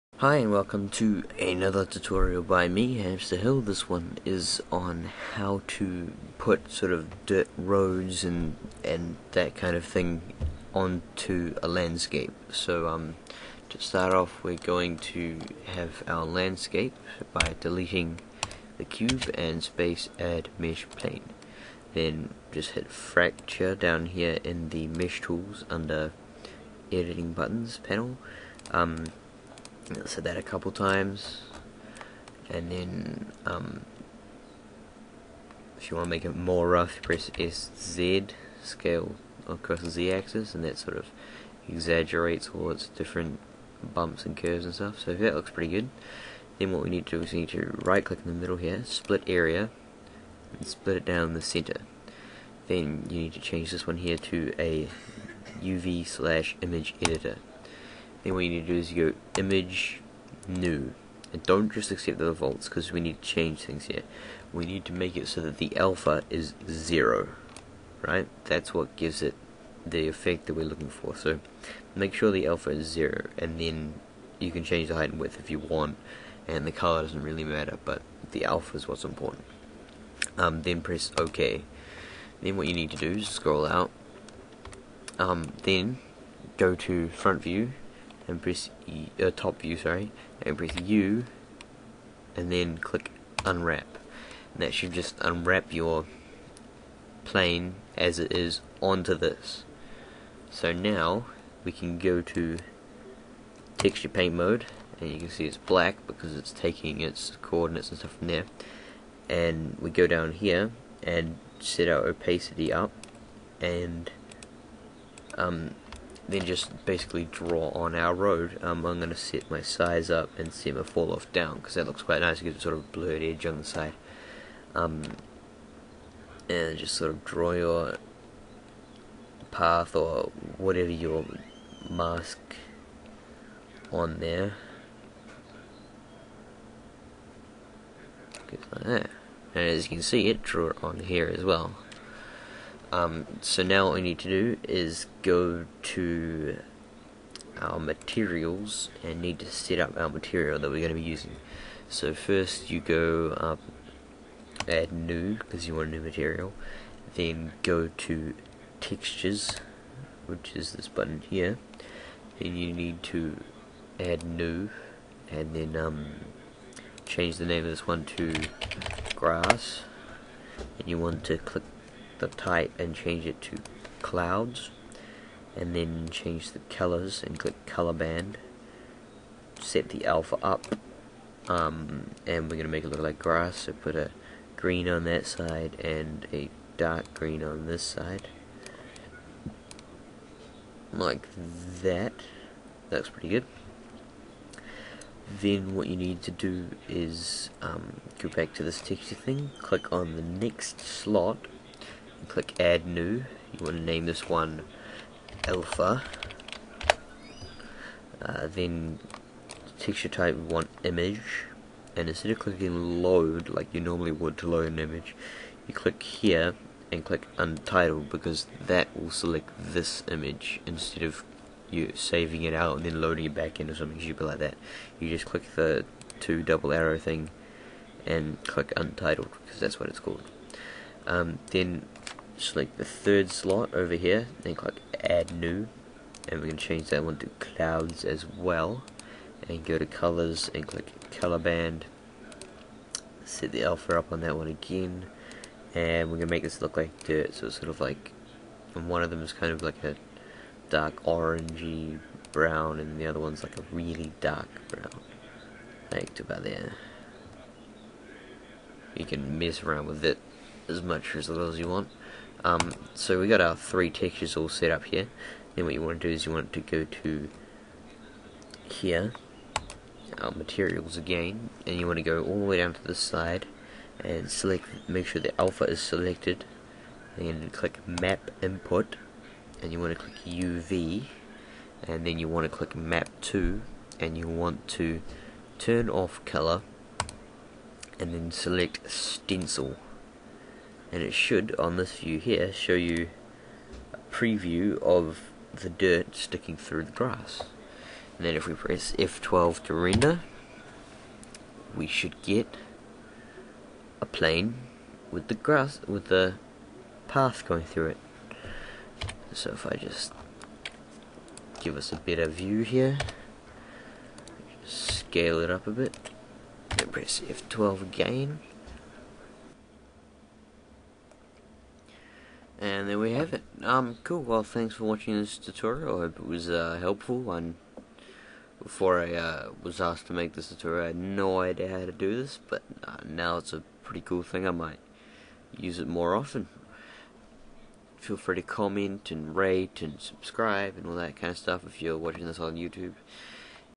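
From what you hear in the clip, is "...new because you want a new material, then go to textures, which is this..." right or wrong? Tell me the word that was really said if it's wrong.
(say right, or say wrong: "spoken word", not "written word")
right.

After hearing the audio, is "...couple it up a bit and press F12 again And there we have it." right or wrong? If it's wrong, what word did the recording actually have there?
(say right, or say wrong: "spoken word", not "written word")
wrong: "scale", not "couple".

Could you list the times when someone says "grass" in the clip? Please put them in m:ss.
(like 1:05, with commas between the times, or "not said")
2:49, 3:03, 4:56, 5:05.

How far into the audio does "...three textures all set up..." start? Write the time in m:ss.
4:23.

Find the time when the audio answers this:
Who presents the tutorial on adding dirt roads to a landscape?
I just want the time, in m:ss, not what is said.
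0:03.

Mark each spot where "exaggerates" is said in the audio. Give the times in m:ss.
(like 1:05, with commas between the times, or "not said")
0:41.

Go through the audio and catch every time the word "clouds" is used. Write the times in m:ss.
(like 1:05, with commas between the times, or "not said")
2:54, 3:57.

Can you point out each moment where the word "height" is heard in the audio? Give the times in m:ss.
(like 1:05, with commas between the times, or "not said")
1:14.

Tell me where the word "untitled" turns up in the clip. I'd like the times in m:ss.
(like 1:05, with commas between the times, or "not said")
3:37, 3:48.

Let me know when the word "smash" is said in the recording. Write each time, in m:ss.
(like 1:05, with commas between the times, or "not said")
not said.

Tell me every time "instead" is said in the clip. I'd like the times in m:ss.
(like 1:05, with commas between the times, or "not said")
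3:32, 3:40.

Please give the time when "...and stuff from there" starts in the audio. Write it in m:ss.
1:47.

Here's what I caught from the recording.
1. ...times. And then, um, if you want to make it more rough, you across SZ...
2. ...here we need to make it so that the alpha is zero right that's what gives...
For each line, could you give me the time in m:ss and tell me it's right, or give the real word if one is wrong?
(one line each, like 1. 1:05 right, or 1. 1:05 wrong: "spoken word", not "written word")
1. 0:30 wrong: "press", not "across"
2. 1:03 right.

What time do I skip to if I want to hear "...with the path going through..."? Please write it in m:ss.
5:05.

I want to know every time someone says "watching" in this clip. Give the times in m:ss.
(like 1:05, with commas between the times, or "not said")
5:24, 5:41.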